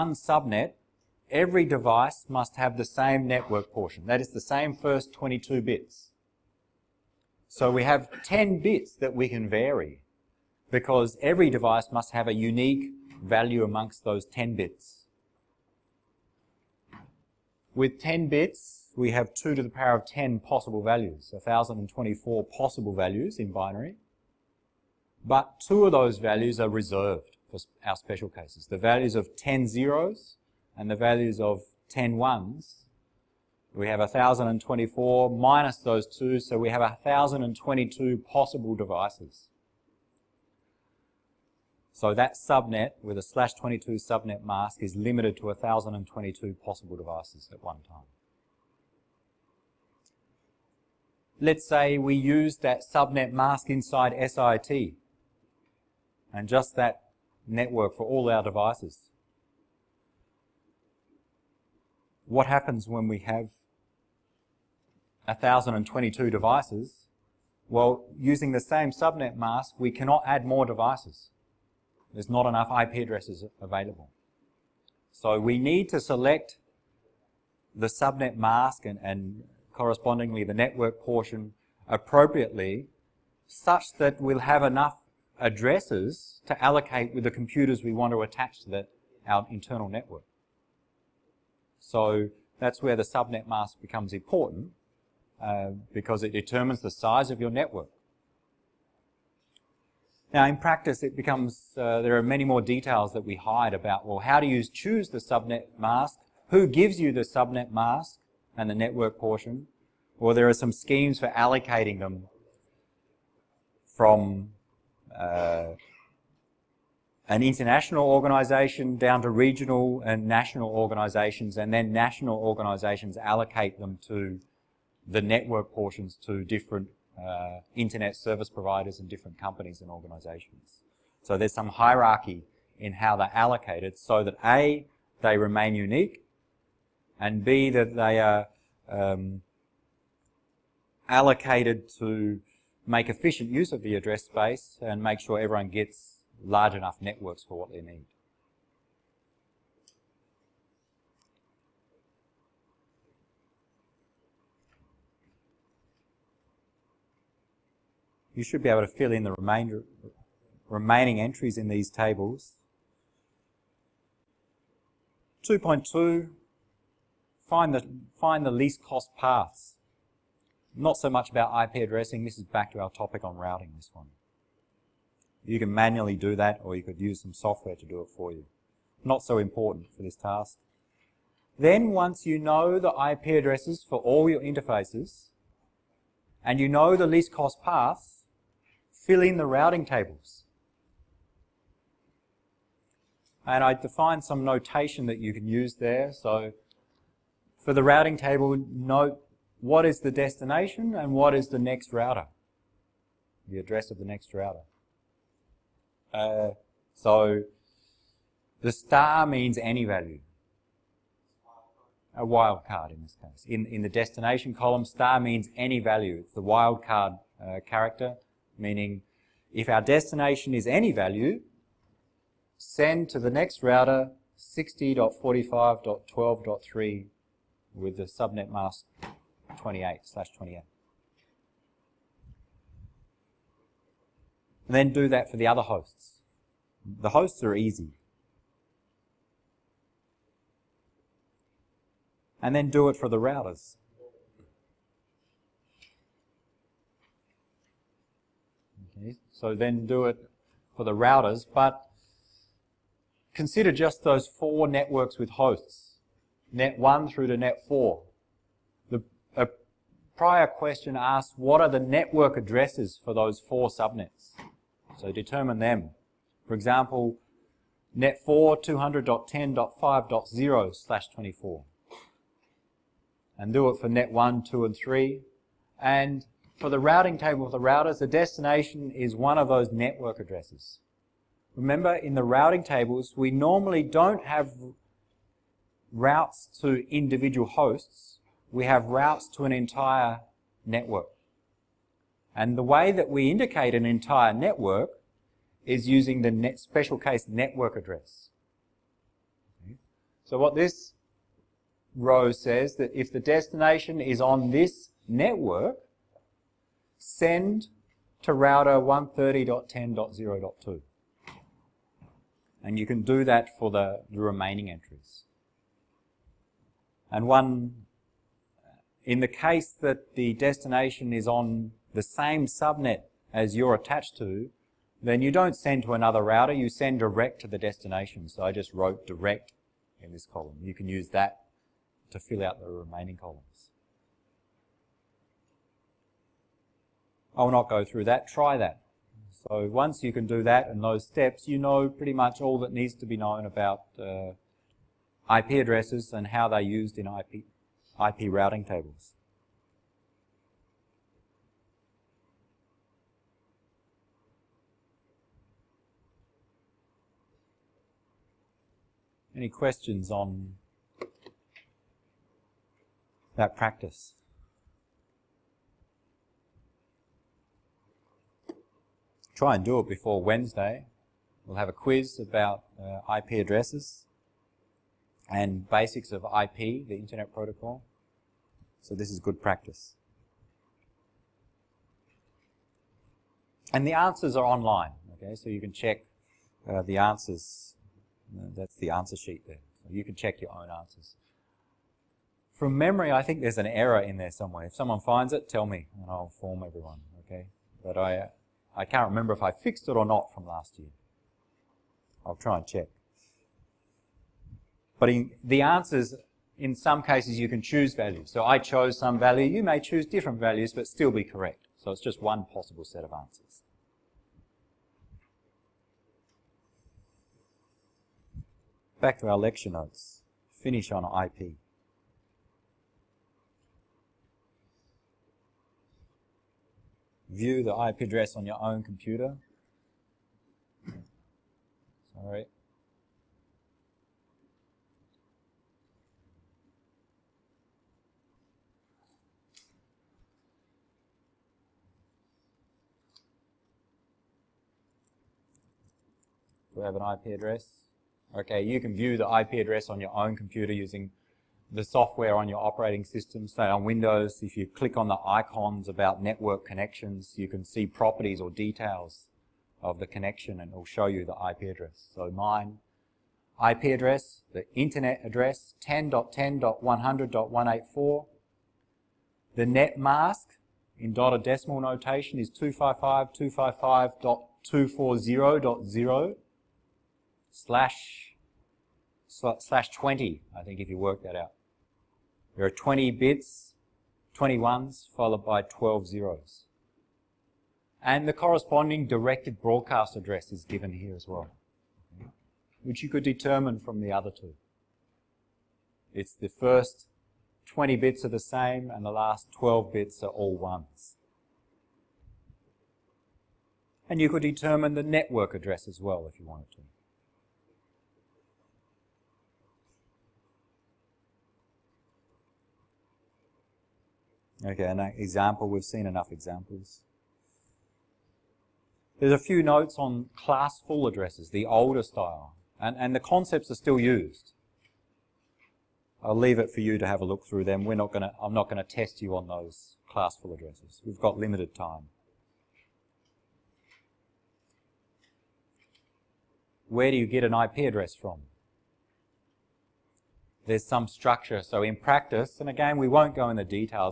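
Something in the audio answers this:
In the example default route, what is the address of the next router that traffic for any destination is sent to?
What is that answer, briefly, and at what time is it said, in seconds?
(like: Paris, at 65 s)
60.45.12.3, at 224 s.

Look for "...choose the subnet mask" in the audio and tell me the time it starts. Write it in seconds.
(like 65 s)
104 s.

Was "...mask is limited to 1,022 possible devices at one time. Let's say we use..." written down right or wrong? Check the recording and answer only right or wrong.
right.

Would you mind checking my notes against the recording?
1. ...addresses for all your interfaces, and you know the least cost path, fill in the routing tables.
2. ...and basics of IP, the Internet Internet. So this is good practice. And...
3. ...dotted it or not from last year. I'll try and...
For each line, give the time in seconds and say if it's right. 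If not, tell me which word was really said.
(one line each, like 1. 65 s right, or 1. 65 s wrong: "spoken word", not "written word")
1. 183 s right
2. 375 s wrong: "Protocol", not "Internet"
3. 399 s wrong: "fixed", not "dotted".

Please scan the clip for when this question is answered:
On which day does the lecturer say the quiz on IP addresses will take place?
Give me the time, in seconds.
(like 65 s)
370 s.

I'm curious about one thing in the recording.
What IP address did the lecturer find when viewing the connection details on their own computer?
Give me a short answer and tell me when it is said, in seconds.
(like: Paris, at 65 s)
10.10.100.184, at 465 s.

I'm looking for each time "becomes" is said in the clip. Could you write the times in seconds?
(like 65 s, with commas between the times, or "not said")
93 s, 101 s.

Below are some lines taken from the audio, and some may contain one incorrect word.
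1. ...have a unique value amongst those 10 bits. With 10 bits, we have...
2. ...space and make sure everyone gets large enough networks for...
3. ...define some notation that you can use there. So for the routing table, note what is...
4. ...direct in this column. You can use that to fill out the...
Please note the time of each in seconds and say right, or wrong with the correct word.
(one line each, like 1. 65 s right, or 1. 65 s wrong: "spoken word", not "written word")
1. 12 s right
2. 144 s right
3. 193 s right
4. 329 s right.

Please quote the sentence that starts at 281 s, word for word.
Remember, in the routing tables, we normally don't have routes to individual hosts.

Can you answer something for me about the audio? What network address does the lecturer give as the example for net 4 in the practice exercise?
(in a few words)
200.10.5.0/24.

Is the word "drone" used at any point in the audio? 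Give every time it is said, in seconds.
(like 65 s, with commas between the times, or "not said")
not said.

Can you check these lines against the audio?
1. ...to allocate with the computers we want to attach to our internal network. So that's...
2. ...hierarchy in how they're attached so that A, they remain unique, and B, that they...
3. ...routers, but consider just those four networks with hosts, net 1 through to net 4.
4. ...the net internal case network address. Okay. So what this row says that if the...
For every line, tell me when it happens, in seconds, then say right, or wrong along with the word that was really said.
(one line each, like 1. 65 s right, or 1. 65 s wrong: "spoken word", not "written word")
1. 86 s right
2. 131 s wrong: "allocated", not "attached"
3. 250 s right
4. 296 s wrong: "special", not "internal".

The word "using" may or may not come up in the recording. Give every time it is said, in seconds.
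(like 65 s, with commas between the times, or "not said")
68 s, 295 s, 450 s.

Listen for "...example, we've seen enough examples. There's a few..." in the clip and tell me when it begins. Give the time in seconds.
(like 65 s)
515 s.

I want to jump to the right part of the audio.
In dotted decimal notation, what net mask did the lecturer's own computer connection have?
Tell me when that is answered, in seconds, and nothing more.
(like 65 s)
472 s.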